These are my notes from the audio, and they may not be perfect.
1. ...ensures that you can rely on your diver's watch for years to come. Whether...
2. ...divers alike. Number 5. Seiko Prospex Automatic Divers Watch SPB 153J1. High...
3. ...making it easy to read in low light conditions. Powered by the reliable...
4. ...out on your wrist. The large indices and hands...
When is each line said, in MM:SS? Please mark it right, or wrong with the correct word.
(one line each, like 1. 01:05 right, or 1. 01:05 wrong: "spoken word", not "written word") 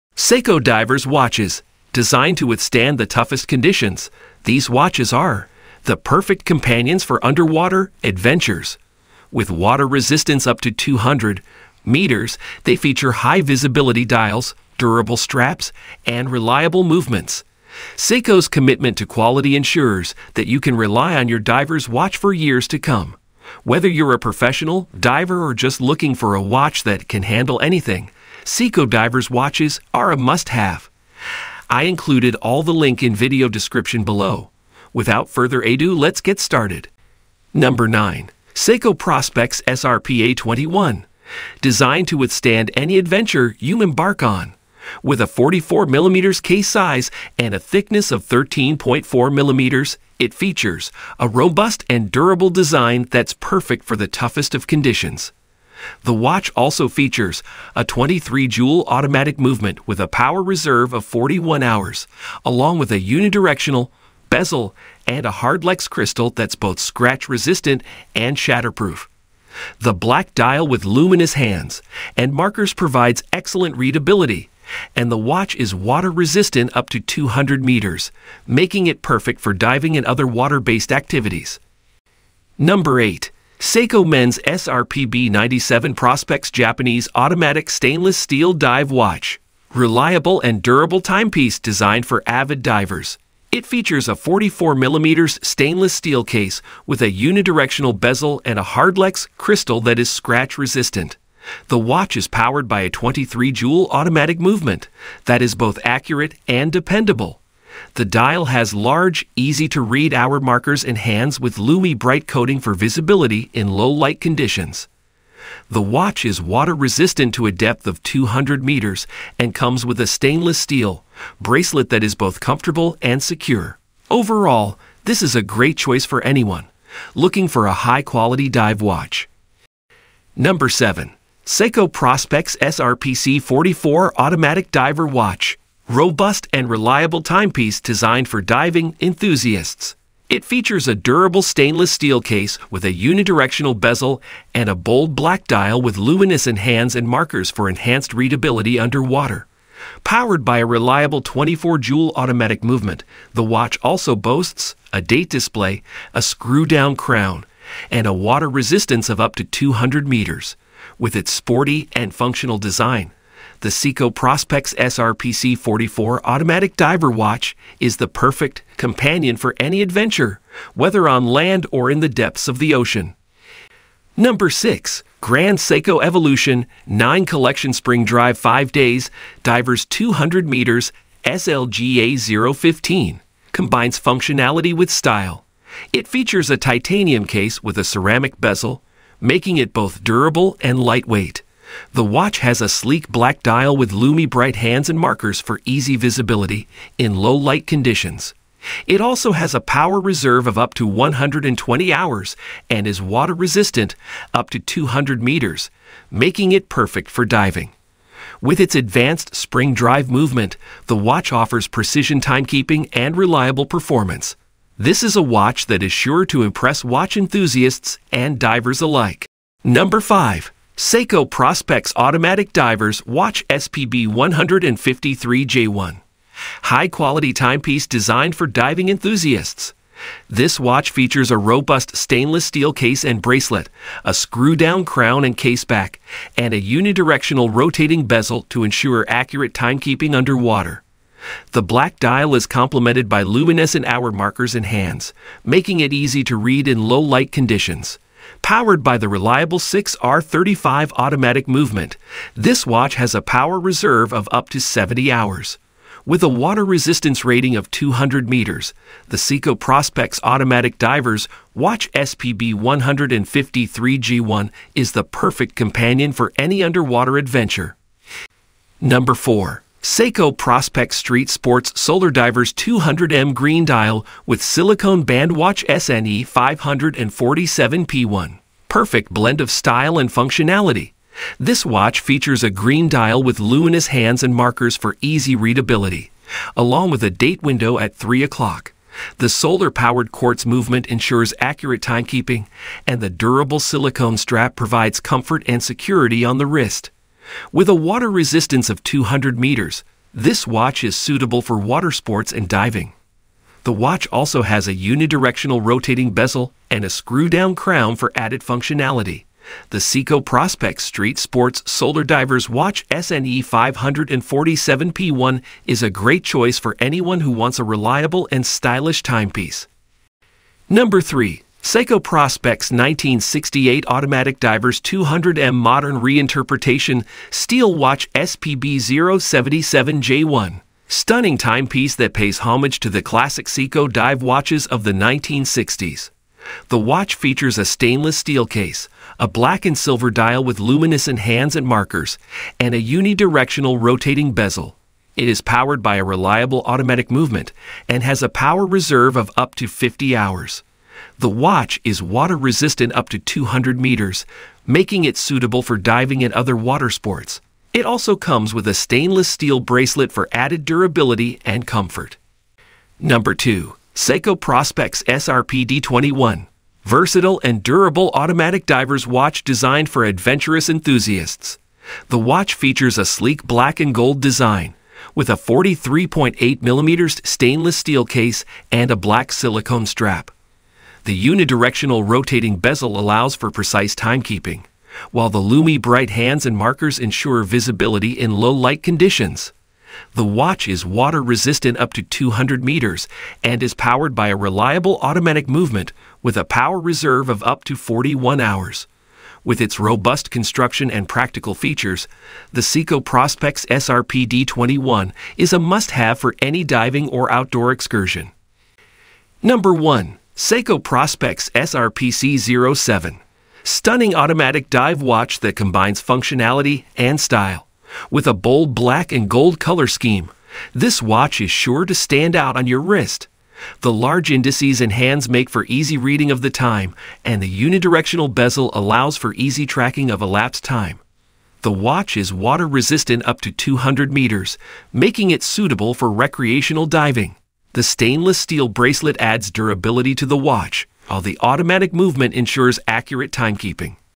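1. 00:19 right
2. 03:38 right
3. 04:05 right
4. 07:02 right.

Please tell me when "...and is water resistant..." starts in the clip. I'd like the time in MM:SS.
03:22.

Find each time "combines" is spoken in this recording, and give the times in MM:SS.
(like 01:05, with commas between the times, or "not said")
03:03, 06:55.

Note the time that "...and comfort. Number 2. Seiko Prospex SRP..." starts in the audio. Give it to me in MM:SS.
06:01.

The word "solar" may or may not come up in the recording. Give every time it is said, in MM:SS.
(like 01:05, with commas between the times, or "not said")
04:31, 04:49, 05:11.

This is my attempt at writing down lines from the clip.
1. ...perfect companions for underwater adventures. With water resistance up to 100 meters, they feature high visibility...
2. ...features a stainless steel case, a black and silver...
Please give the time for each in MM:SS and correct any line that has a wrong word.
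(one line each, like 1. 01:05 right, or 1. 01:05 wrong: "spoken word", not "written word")
1. 00:05 wrong: "200", not "100"
2. 05:37 right.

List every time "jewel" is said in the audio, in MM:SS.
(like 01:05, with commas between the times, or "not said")
00:57, 01:43, 02:31.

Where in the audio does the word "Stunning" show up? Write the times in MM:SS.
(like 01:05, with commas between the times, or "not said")
05:30, 06:53.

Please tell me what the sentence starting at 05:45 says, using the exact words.
It is powered by a reliable automatic movement and has a power reserve of up to 50 hours.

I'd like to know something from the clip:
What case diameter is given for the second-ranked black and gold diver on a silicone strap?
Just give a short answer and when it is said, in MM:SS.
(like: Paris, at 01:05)
43.8 mm, at 06:15.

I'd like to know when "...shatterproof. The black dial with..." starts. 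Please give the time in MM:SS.
01:08.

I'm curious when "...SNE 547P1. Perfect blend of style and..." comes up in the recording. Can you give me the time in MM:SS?
04:35.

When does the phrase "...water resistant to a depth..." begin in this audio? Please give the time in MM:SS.
01:56.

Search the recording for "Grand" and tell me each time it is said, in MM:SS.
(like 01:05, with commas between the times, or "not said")
02:55.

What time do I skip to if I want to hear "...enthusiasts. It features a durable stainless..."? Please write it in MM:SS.
02:19.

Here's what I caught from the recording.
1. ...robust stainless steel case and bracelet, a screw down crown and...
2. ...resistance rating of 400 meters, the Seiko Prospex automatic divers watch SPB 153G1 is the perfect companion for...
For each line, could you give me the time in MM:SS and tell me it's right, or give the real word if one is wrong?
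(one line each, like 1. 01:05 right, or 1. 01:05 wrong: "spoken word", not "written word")
1. 03:51 right
2. 04:16 wrong: "200", not "400".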